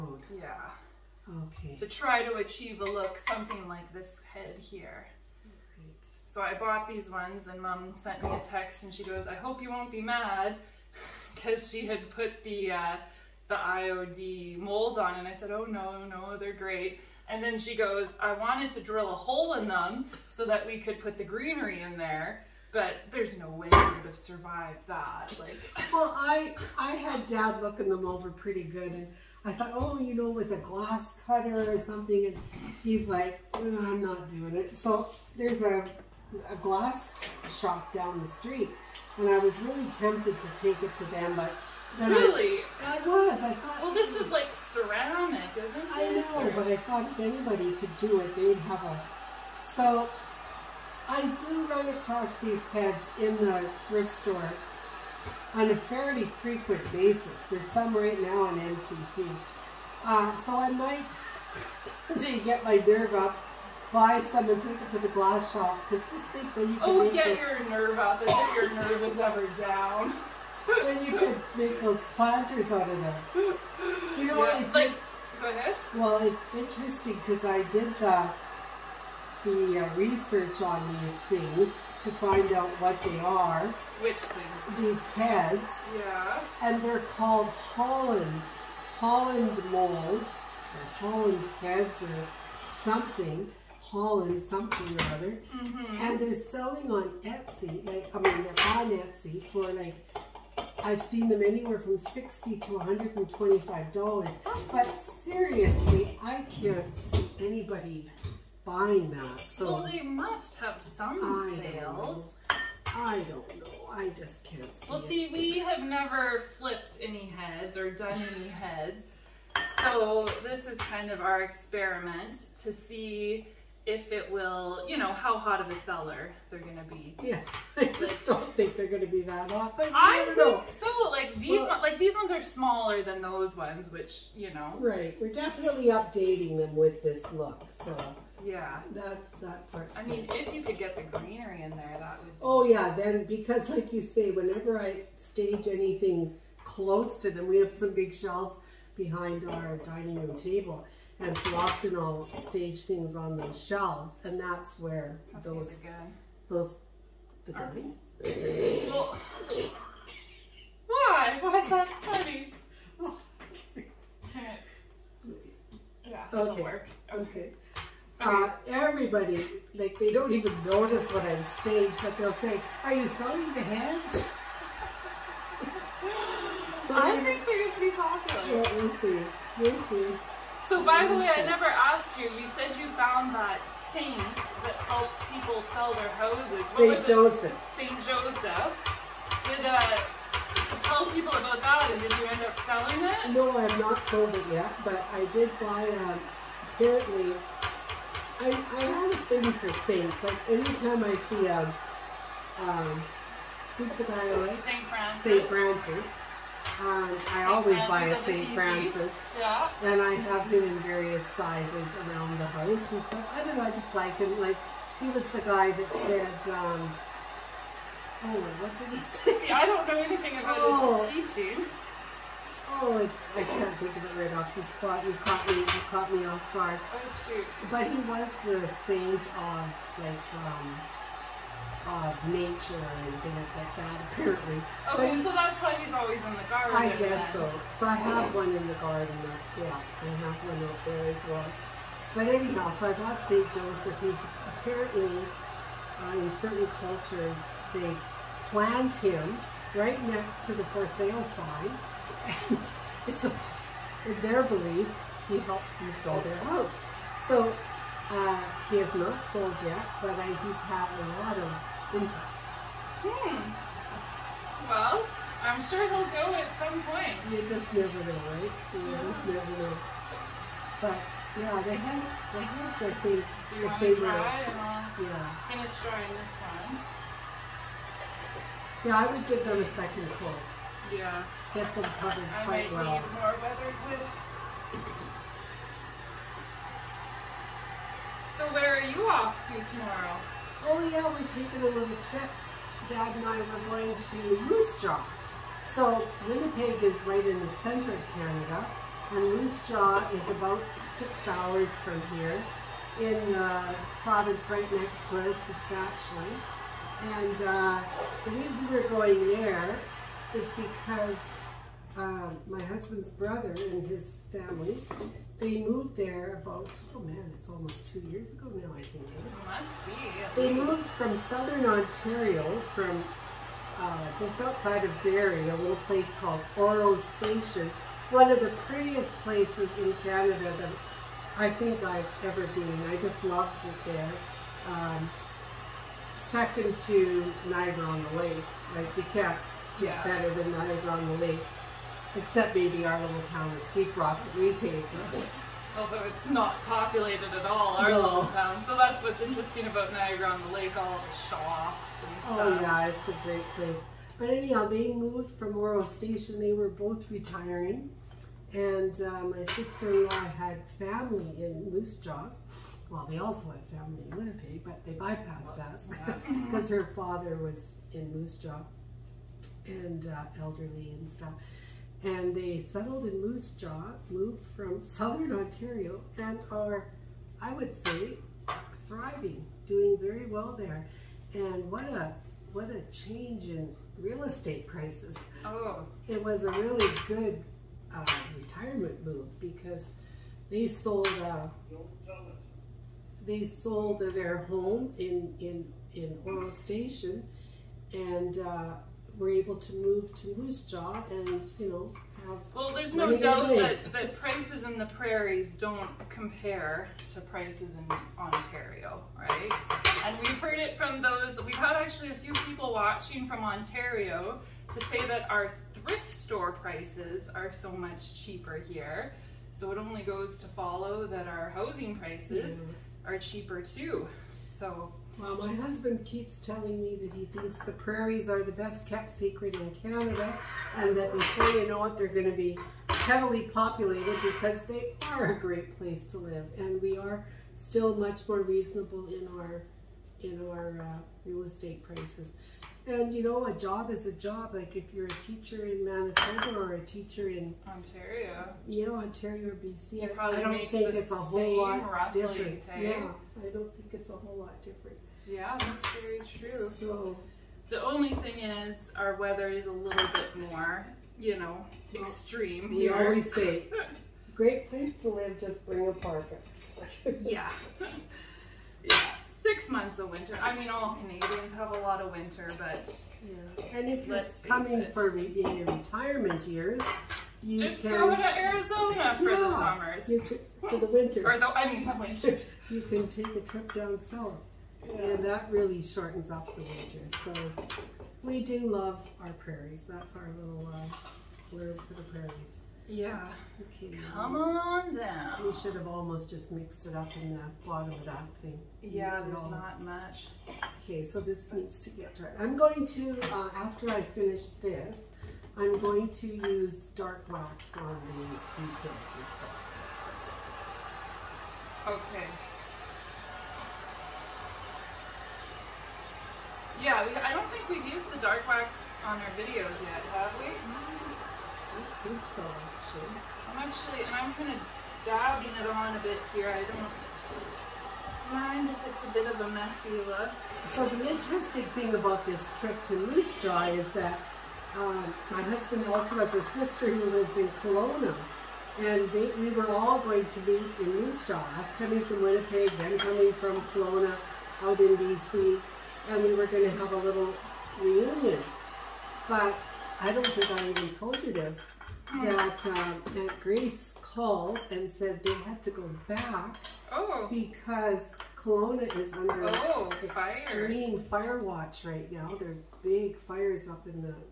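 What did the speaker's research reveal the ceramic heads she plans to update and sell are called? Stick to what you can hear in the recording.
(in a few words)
Holland molds.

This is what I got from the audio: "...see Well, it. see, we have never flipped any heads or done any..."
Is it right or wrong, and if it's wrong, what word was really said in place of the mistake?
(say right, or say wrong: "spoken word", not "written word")
right.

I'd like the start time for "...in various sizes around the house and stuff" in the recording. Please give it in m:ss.
3:30.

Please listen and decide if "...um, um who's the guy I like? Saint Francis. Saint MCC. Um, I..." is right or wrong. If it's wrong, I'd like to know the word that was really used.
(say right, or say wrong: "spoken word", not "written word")
wrong: "Francis", not "MCC".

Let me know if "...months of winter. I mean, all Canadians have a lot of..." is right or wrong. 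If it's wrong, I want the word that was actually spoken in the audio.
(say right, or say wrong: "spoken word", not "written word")
right.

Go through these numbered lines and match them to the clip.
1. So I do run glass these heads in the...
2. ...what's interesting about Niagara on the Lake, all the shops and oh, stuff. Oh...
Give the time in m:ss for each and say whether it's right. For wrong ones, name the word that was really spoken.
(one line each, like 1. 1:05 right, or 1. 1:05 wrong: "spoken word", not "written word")
1. 0:49 wrong: "across", not "glass"
2. 5:49 right.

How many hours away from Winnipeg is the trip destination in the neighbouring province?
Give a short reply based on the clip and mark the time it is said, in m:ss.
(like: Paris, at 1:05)
6, at 5:00.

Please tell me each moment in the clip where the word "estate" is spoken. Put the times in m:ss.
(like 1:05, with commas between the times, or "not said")
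6:24, 7:21.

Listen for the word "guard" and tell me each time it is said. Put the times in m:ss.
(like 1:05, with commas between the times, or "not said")
3:46.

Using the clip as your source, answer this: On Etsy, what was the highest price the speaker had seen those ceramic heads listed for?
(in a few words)
$125.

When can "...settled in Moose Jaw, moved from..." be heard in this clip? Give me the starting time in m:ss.
6:12.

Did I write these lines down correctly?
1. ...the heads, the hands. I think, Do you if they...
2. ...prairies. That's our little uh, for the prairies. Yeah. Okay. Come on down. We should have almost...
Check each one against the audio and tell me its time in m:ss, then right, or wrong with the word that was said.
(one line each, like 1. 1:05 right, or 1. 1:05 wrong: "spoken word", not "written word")
1. 4:31 right
2. 8:09 right.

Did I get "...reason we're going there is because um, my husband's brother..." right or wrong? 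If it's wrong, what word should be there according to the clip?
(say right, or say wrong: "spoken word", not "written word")
right.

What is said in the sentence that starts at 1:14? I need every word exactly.
You know, yeah, it's like, go ahead.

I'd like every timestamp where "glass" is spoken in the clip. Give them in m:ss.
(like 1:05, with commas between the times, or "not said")
0:30, 0:36, 1:05.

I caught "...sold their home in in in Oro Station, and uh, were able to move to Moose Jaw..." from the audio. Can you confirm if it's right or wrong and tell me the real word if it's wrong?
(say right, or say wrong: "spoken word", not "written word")
right.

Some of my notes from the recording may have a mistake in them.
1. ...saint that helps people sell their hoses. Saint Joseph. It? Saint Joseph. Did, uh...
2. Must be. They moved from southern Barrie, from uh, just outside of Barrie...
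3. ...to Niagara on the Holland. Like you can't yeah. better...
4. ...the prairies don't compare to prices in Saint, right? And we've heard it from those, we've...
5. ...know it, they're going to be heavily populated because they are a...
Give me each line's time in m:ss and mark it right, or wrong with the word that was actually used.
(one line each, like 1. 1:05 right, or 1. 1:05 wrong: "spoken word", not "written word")
1. 3:03 right
2. 5:19 wrong: "Ontario", not "Barrie"
3. 5:36 wrong: "Lake", not "Holland"
4. 6:44 wrong: "Ontario", not "Saint"
5. 7:11 right.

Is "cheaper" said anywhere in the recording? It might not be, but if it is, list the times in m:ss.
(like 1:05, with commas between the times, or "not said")
6:58, 7:03.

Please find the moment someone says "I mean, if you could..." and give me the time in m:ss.
2:19.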